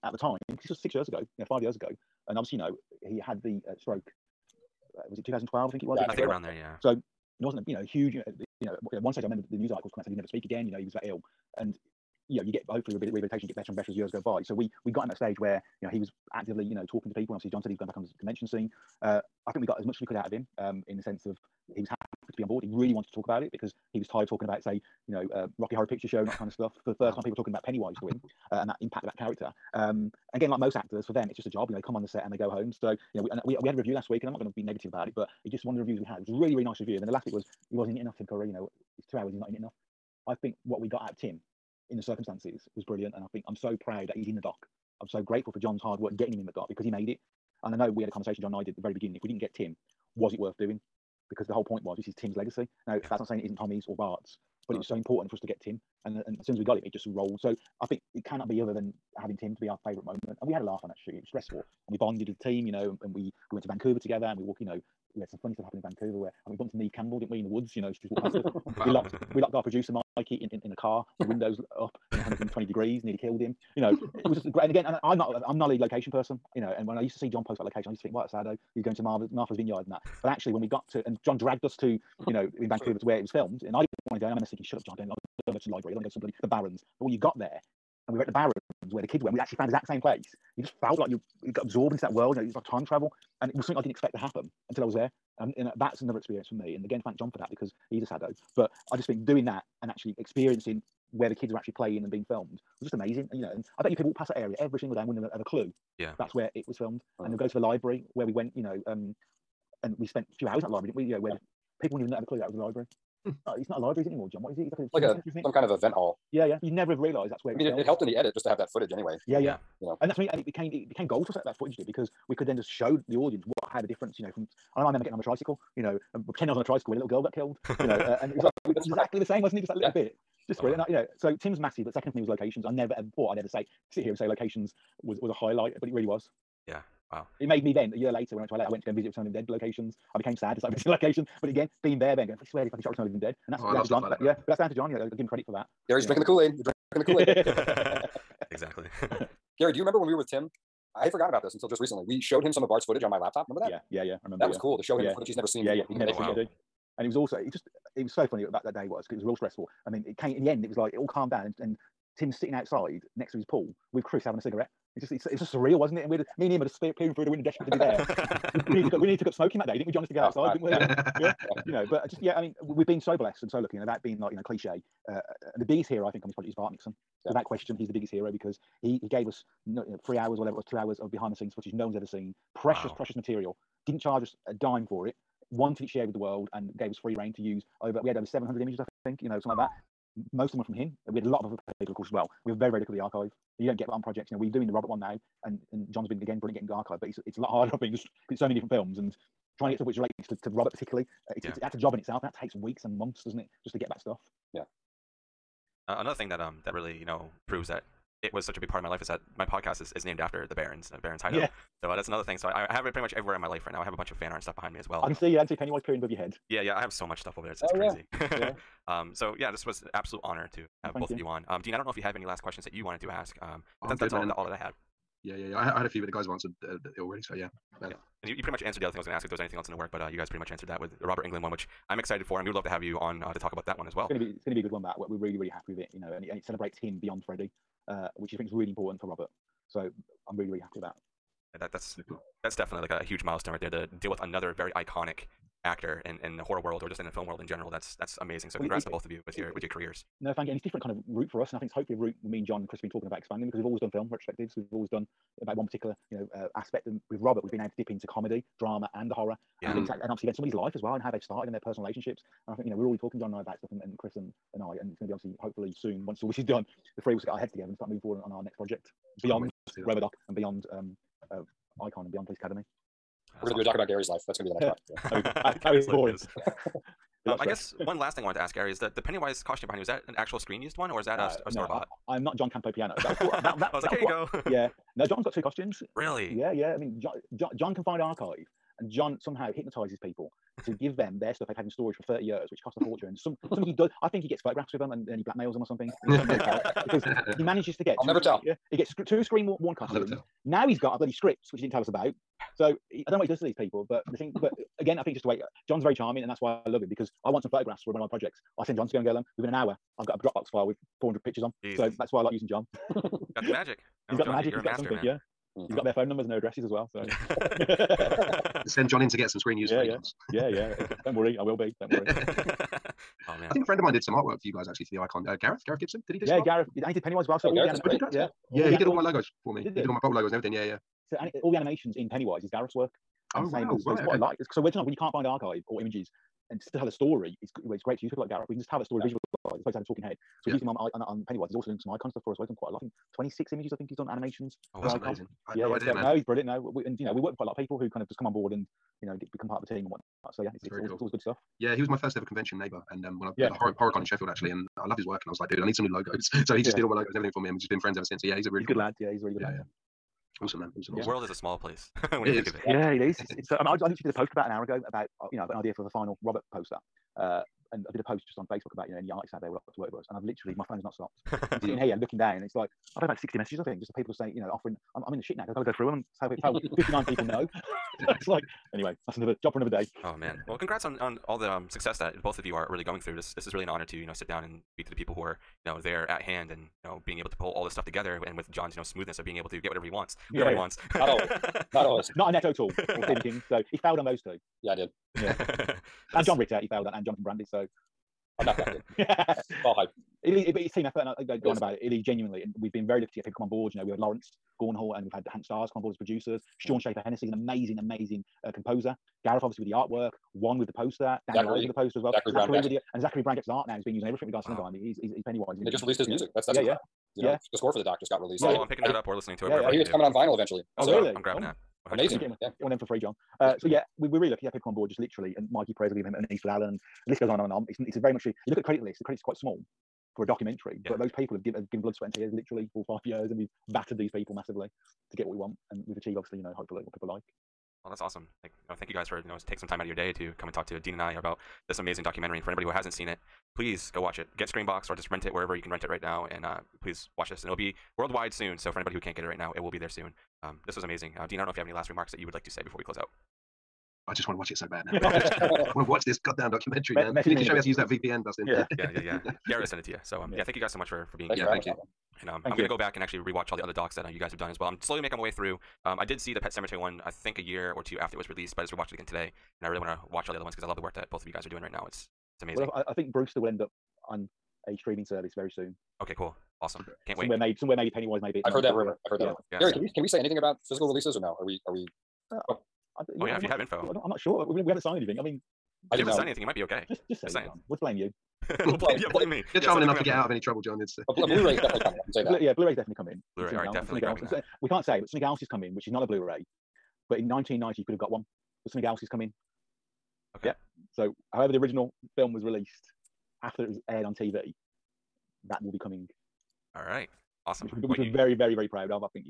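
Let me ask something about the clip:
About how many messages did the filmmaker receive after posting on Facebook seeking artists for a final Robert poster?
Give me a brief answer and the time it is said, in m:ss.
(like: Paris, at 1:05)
60, at 6:13.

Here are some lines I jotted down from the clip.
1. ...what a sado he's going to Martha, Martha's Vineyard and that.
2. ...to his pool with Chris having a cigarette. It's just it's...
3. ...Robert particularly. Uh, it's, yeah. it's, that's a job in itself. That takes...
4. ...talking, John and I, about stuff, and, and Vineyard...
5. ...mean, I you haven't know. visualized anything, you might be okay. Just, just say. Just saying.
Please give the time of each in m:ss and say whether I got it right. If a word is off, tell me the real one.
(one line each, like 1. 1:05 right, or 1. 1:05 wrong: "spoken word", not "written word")
1. 1:18 right
2. 2:43 right
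3. 3:20 right
4. 4:22 wrong: "Chris", not "Vineyard"
5. 8:05 wrong: "signed", not "visualized".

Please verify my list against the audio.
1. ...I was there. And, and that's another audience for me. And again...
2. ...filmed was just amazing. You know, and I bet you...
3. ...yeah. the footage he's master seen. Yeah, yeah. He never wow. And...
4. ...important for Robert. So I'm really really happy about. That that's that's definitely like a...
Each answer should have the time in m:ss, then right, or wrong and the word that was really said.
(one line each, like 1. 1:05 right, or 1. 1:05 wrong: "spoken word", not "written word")
1. 1:34 wrong: "experience", not "audience"
2. 1:42 right
3. 2:35 wrong: "never", not "master"
4. 3:58 right.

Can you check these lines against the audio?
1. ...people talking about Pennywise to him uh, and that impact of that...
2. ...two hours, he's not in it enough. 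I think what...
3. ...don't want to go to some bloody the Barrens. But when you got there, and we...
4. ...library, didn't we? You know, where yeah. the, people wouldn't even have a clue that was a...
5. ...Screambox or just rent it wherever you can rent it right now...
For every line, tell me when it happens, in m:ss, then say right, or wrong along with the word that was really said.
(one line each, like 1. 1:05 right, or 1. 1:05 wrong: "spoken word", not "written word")
1. 0:27 right
2. 0:39 right
3. 1:25 right
4. 1:50 right
5. 7:24 right.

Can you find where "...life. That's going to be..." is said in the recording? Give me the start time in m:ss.
4:34.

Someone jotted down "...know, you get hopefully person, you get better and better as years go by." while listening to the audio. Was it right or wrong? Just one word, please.
wrong.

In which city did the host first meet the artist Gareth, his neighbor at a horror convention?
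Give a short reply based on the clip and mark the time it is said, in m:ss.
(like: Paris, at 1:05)
Sheffield, at 5:54.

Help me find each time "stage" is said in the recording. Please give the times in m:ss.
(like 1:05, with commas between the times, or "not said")
0:09, 0:15.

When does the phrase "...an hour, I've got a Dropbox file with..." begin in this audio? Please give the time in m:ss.
5:09.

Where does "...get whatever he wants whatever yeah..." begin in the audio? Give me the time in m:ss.
6:29.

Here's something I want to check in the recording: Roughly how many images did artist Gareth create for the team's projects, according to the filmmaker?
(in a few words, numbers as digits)
26.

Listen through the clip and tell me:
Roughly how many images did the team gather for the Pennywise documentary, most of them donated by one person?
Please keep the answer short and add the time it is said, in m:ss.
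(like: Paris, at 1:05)
700, at 3:08.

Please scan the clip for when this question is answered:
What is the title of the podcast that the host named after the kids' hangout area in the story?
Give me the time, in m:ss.
3:31.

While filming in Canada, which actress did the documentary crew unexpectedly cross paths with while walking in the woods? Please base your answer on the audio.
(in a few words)
Neve Campbell.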